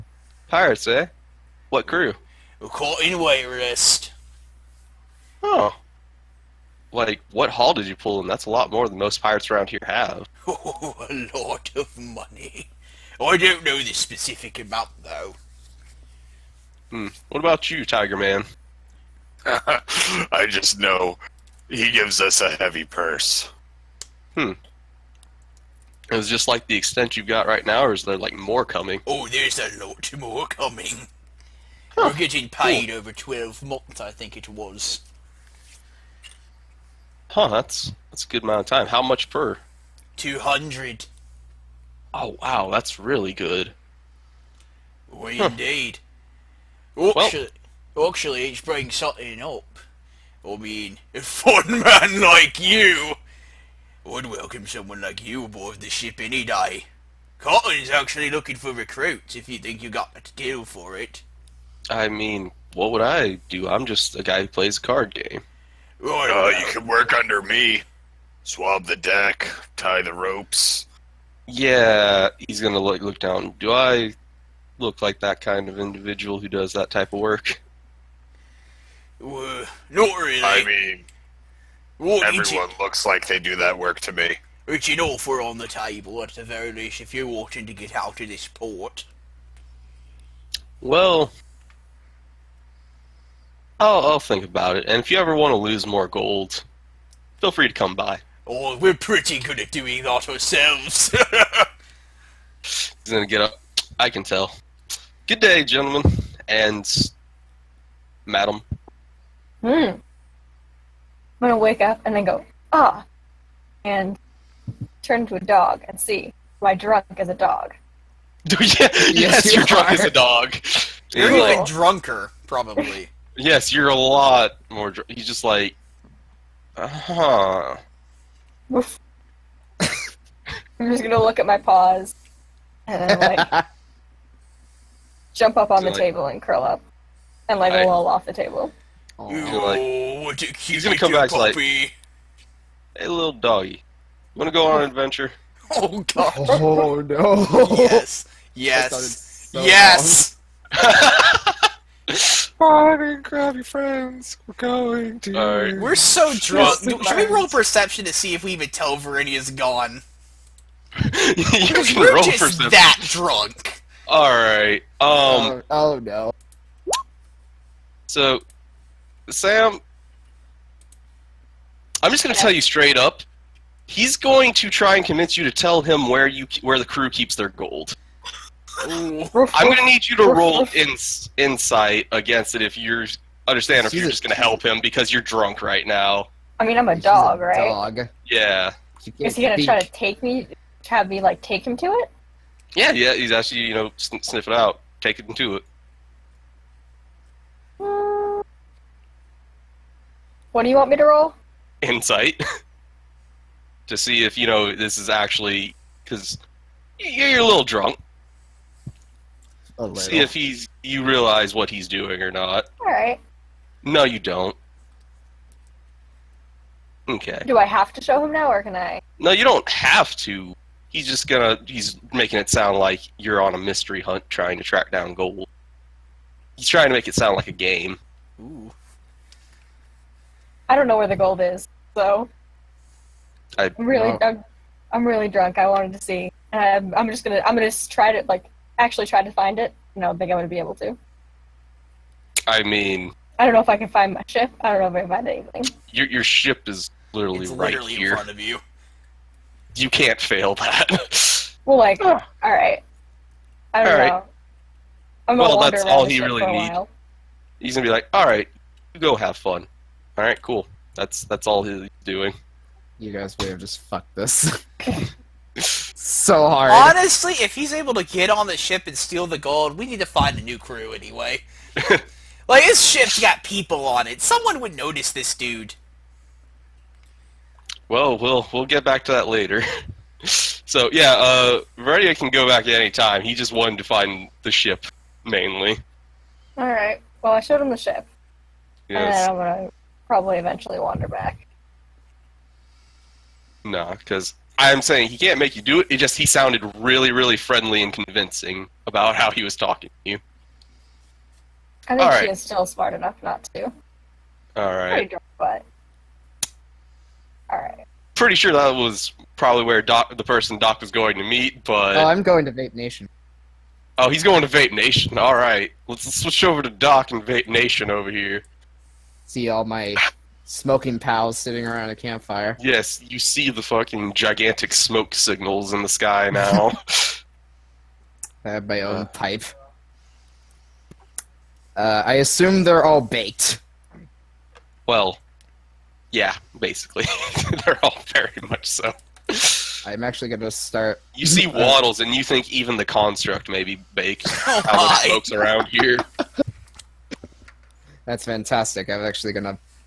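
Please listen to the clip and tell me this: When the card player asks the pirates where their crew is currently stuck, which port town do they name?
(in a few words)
Wayrest.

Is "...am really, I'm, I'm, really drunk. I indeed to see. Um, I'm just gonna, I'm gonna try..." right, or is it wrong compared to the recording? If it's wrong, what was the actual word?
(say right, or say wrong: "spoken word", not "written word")
wrong: "wanted", not "indeed".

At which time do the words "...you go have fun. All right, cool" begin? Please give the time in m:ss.
4:18.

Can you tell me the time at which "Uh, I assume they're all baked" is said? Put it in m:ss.
5:31.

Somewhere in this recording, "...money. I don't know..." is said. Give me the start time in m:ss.
0:11.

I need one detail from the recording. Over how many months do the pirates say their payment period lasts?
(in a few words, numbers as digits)
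12.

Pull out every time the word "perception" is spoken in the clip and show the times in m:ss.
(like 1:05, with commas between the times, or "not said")
2:37, 2:42.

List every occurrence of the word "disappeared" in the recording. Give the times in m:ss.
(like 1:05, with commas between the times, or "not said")
not said.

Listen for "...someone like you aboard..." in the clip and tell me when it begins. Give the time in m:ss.
0:54.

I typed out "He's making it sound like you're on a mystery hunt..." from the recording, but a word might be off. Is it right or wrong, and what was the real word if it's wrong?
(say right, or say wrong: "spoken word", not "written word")
right.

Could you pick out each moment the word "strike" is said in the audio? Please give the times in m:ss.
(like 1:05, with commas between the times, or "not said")
not said.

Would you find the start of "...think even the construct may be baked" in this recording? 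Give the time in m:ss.
5:42.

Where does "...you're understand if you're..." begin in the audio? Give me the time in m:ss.
3:02.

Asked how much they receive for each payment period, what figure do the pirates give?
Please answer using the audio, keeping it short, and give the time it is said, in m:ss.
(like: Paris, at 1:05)
200, at 0:40.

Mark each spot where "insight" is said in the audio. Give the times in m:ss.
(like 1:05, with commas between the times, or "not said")
3:01, 3:21.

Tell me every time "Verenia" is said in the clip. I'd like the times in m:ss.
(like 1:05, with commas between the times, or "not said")
2:38, 4:41.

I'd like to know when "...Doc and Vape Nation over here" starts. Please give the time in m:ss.
5:16.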